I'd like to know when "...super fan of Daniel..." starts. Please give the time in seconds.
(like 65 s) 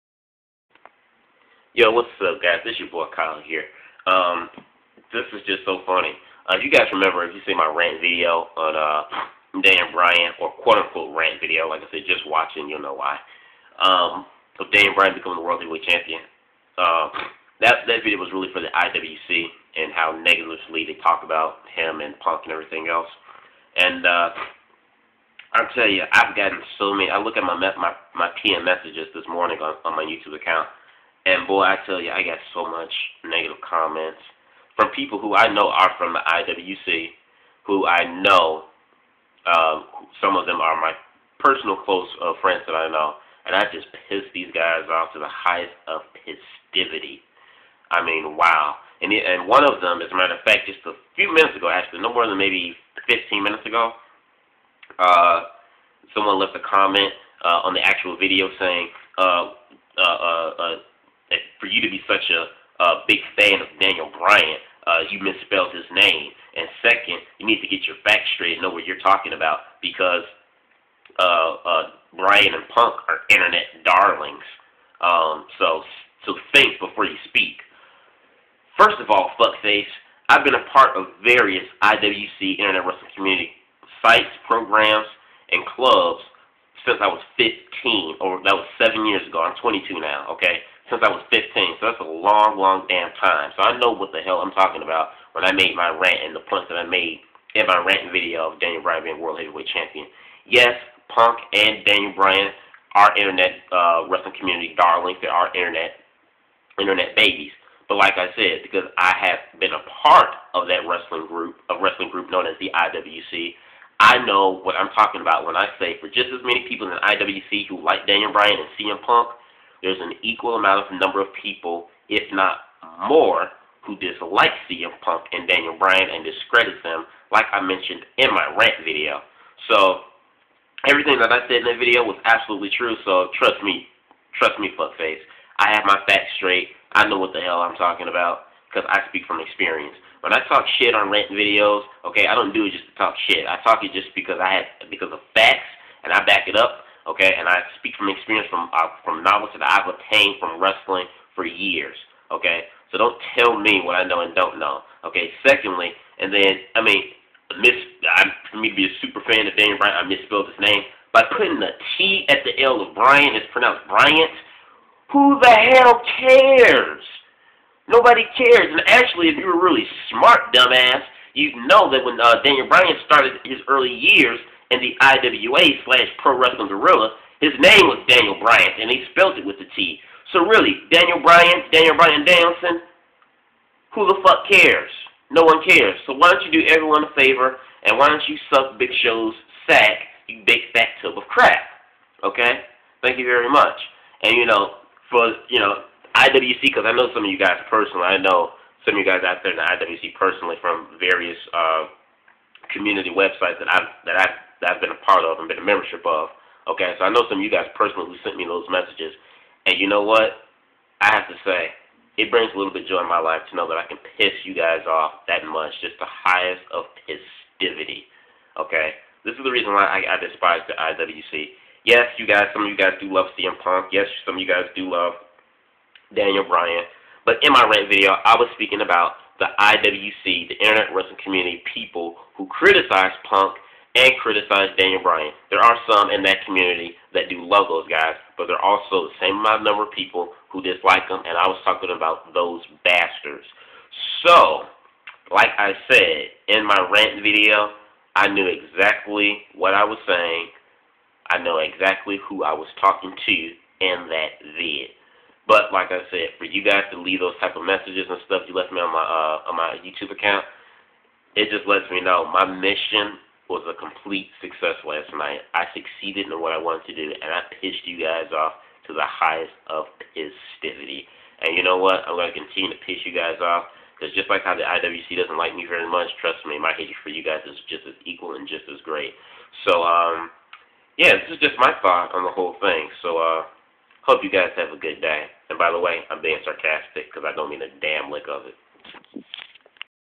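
159 s.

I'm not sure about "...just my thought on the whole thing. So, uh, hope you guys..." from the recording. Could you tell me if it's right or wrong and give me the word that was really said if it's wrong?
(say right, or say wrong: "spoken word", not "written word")
right.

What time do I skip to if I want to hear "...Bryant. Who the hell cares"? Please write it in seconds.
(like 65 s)
163 s.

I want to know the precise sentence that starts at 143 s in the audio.
I talk it just because I have because of facts and I back it up okay?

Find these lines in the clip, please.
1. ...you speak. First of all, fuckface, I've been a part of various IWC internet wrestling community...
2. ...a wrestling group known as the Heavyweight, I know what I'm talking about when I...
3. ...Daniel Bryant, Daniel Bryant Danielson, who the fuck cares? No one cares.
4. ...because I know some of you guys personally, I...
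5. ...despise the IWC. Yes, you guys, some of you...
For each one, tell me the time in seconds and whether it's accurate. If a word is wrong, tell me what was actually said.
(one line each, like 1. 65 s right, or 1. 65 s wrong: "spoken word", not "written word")
1. 77 s right
2. 111 s wrong: "IWC", not "Heavyweight"
3. 180 s right
4. 196 s right
5. 220 s right.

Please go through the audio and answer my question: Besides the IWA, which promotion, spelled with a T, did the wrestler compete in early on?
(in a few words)
Pro Wrestling Guerrilla.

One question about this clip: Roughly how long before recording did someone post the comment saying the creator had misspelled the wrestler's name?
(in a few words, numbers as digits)
15 minutes.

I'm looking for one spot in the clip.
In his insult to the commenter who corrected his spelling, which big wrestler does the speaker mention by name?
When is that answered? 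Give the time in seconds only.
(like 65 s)
188 s.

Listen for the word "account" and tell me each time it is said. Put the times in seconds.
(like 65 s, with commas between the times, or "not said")
30 s, 260 s.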